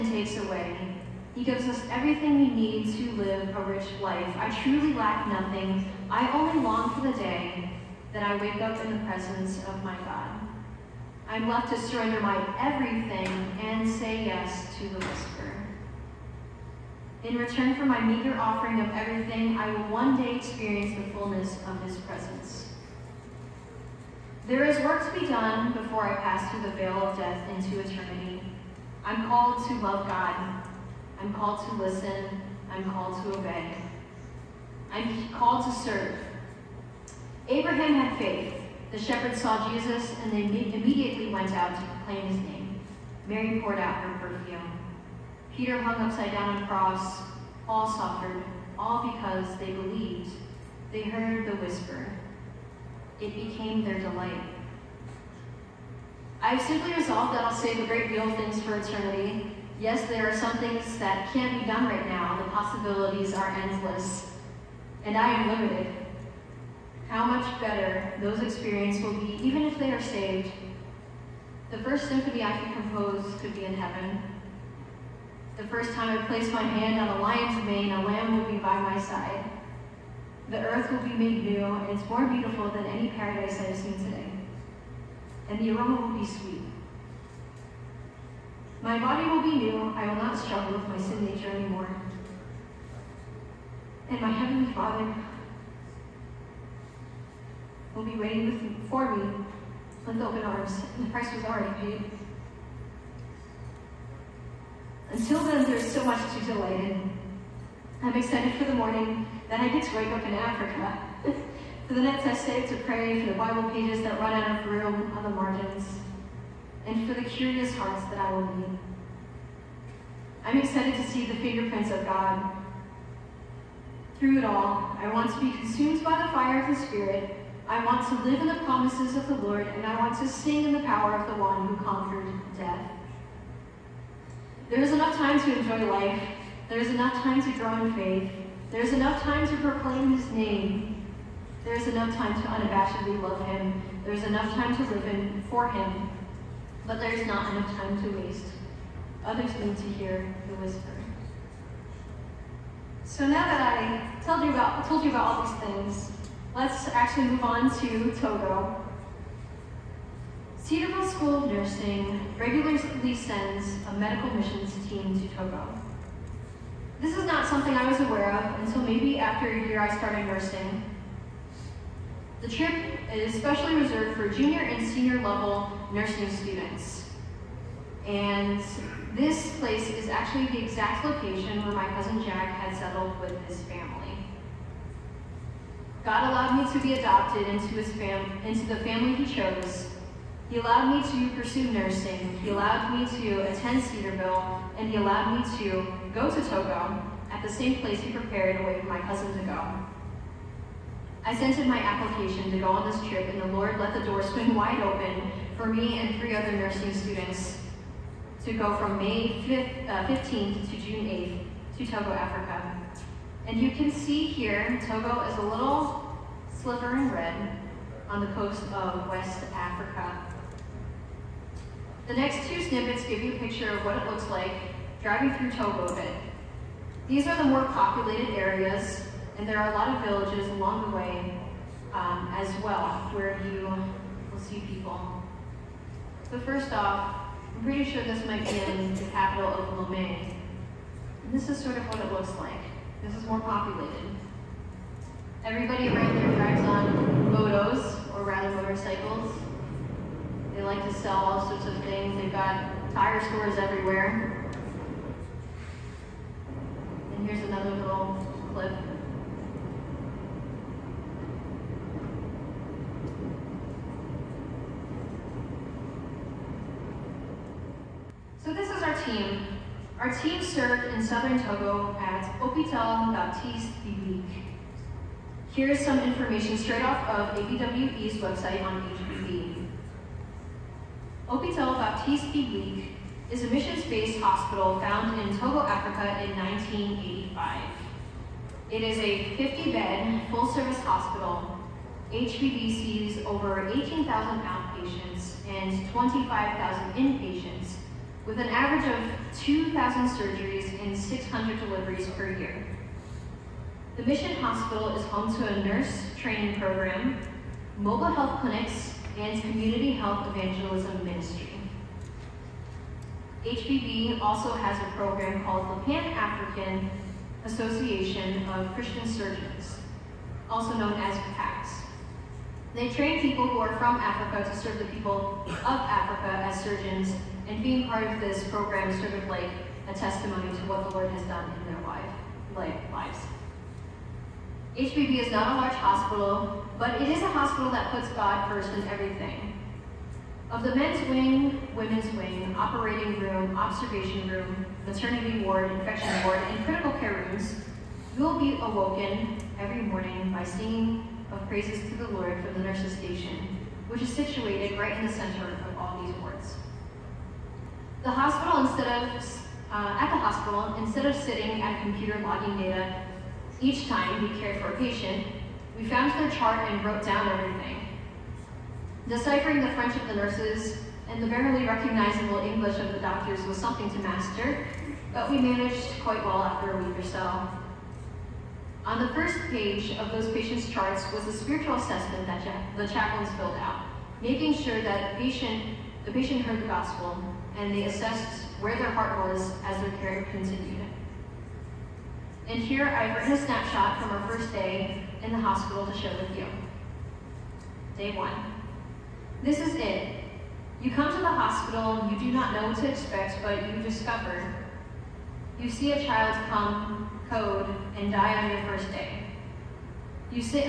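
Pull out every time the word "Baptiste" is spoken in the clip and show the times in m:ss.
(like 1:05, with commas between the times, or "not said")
4:33, 4:41.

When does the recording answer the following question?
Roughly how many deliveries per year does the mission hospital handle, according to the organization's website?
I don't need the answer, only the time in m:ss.
5:00.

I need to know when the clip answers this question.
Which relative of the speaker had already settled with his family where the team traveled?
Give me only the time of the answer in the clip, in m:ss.
3:01.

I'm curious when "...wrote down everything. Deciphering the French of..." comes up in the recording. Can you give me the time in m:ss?
6:06.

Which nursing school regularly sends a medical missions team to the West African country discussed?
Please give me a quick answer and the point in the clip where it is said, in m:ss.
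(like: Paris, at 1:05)
Cedarville School of Nursing, at 2:40.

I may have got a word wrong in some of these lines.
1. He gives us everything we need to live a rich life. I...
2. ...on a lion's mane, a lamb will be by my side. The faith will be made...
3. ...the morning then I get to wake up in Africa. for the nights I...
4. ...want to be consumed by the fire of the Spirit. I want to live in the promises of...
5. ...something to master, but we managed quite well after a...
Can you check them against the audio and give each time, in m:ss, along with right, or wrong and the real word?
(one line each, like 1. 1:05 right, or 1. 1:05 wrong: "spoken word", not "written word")
1. 0:01 right
2. 1:16 wrong: "earth", not "faith"
3. 1:48 right
4. 2:05 right
5. 6:13 right.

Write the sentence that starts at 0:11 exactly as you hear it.
I'm left to surrender my everything and say yes to the whisper.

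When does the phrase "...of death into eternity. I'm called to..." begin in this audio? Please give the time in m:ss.
0:27.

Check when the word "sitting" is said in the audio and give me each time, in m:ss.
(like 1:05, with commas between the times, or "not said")
6:01.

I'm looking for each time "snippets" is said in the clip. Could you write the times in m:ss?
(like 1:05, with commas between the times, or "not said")
3:42.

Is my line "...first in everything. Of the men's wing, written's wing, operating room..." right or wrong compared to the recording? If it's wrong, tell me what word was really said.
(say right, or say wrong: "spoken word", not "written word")
wrong: "women", not "written".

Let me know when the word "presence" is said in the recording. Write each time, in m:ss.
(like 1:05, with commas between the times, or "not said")
0:09, 0:21.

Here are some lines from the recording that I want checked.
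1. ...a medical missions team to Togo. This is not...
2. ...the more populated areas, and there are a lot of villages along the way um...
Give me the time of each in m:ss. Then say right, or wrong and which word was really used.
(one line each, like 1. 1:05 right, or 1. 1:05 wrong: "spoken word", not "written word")
1. 2:43 right
2. 3:47 right.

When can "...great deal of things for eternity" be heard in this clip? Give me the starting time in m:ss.
0:57.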